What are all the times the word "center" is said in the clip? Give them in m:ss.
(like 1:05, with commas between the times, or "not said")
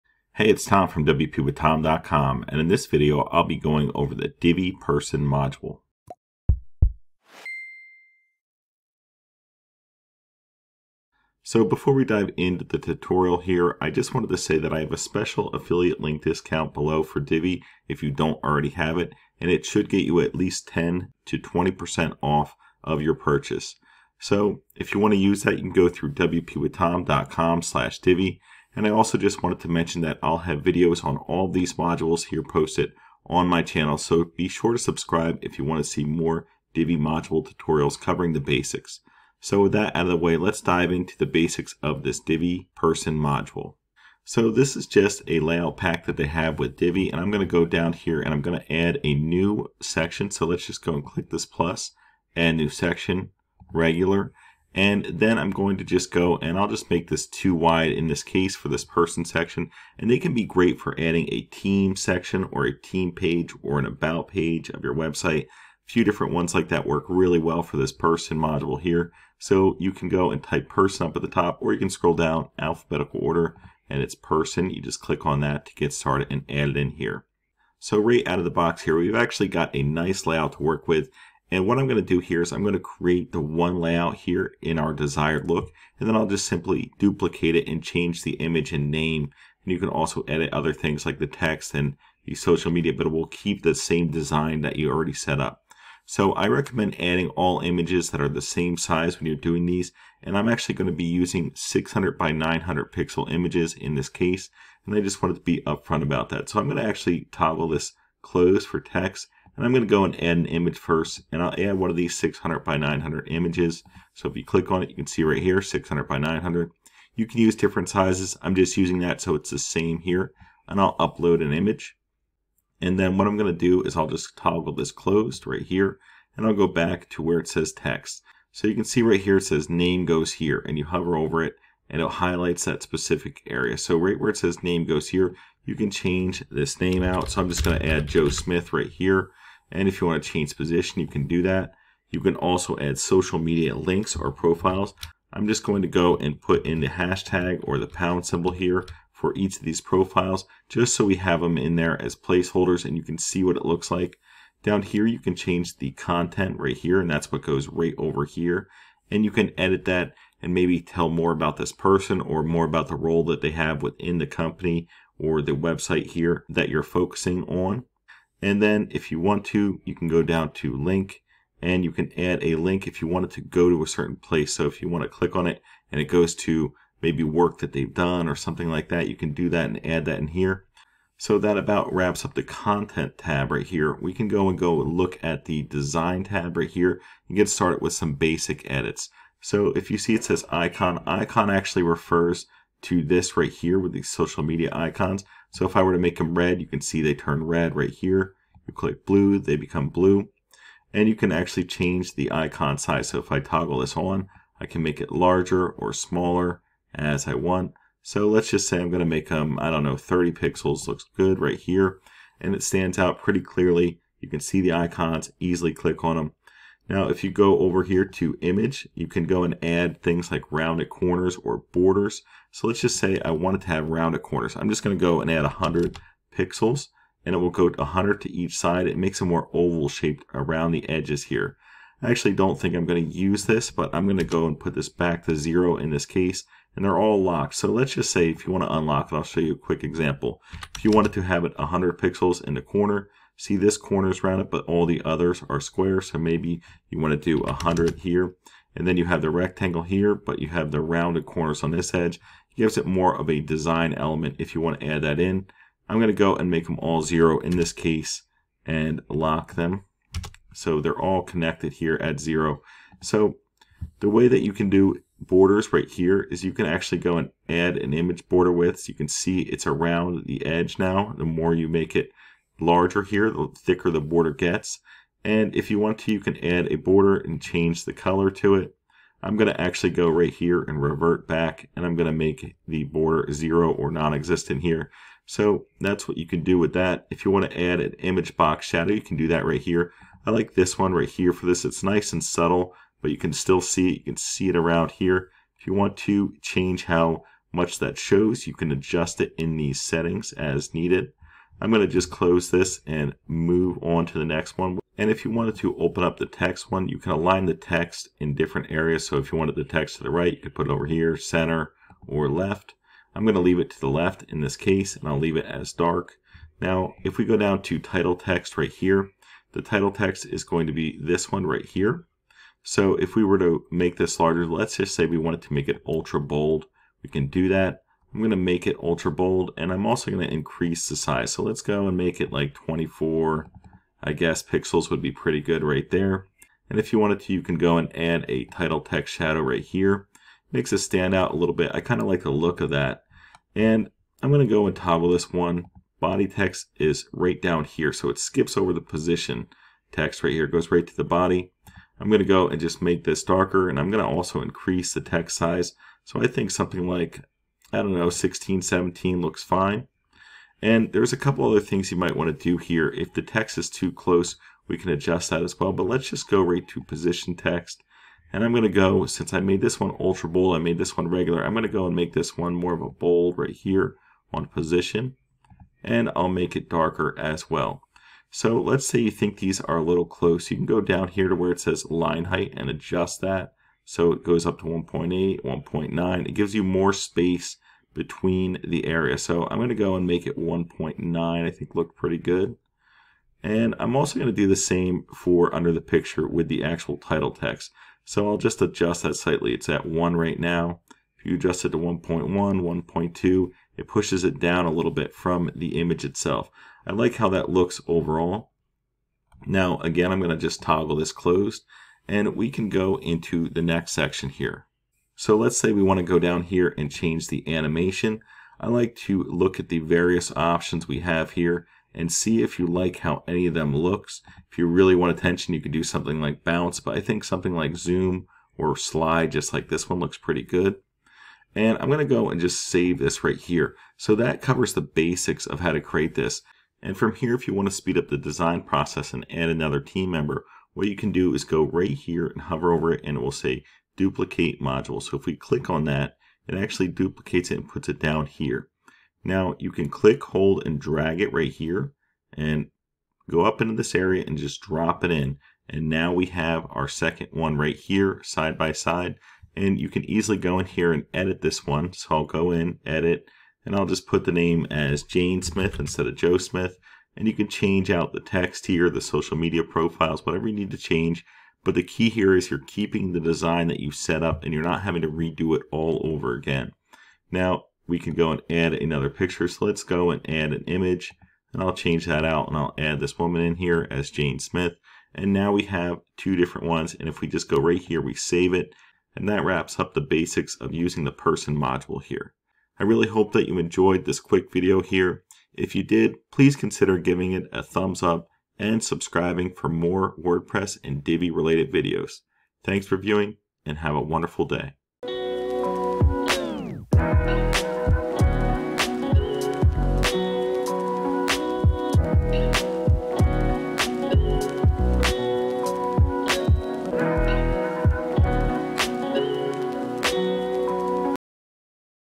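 5:11.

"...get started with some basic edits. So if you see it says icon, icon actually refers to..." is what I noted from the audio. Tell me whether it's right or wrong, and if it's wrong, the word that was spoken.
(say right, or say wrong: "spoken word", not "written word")
right.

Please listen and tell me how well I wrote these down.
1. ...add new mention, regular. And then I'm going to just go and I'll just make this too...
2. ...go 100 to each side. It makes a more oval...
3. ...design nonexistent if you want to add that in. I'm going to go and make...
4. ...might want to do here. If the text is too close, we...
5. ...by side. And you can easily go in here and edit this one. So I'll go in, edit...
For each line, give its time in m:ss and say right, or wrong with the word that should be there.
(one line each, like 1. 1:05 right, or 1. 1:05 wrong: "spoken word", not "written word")
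1. 0:52 wrong: "section", not "mention"
2. 3:47 right
3. 4:13 wrong: "element", not "nonexistent"
4. 6:01 right
5. 7:38 right.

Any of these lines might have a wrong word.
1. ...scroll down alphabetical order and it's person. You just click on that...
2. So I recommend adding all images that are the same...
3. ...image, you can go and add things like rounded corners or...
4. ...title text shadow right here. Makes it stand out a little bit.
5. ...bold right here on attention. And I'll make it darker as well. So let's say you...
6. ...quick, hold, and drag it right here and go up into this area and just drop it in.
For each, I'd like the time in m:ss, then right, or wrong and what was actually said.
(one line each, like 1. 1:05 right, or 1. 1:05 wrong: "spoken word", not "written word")
1. 1:11 right
2. 1:36 right
3. 3:38 right
4. 5:38 right
5. 6:12 wrong: "position", not "attention"
6. 7:29 wrong: "click", not "quick".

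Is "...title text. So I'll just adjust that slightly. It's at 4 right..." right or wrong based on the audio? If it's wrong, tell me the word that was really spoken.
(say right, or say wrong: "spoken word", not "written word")
wrong: "1", not "4".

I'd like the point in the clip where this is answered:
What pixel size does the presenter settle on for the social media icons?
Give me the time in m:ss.
3:29.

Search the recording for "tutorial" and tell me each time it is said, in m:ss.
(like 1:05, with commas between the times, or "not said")
0:12, 0:37.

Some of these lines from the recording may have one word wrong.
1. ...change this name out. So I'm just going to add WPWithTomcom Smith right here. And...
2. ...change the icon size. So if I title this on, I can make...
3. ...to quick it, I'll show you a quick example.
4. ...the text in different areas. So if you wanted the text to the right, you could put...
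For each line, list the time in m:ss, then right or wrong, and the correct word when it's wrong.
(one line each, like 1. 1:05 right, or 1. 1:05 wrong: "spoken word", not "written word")
1. 2:15 wrong: "Joe", not "WPWithTomcom"
2. 3:21 wrong: "toggle", not "title"
3. 3:58 wrong: "unlock", not "quick"
4. 5:07 right.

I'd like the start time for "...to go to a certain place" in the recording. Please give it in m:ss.
2:53.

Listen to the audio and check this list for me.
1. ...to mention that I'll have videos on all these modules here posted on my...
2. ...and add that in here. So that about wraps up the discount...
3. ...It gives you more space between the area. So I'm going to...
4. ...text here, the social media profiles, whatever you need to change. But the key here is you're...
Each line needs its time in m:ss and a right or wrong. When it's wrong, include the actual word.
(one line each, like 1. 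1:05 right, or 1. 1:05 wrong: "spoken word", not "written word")
1. 0:29 right
2. 2:59 wrong: "content", not "discount"
3. 6:26 right
4. 7:48 right.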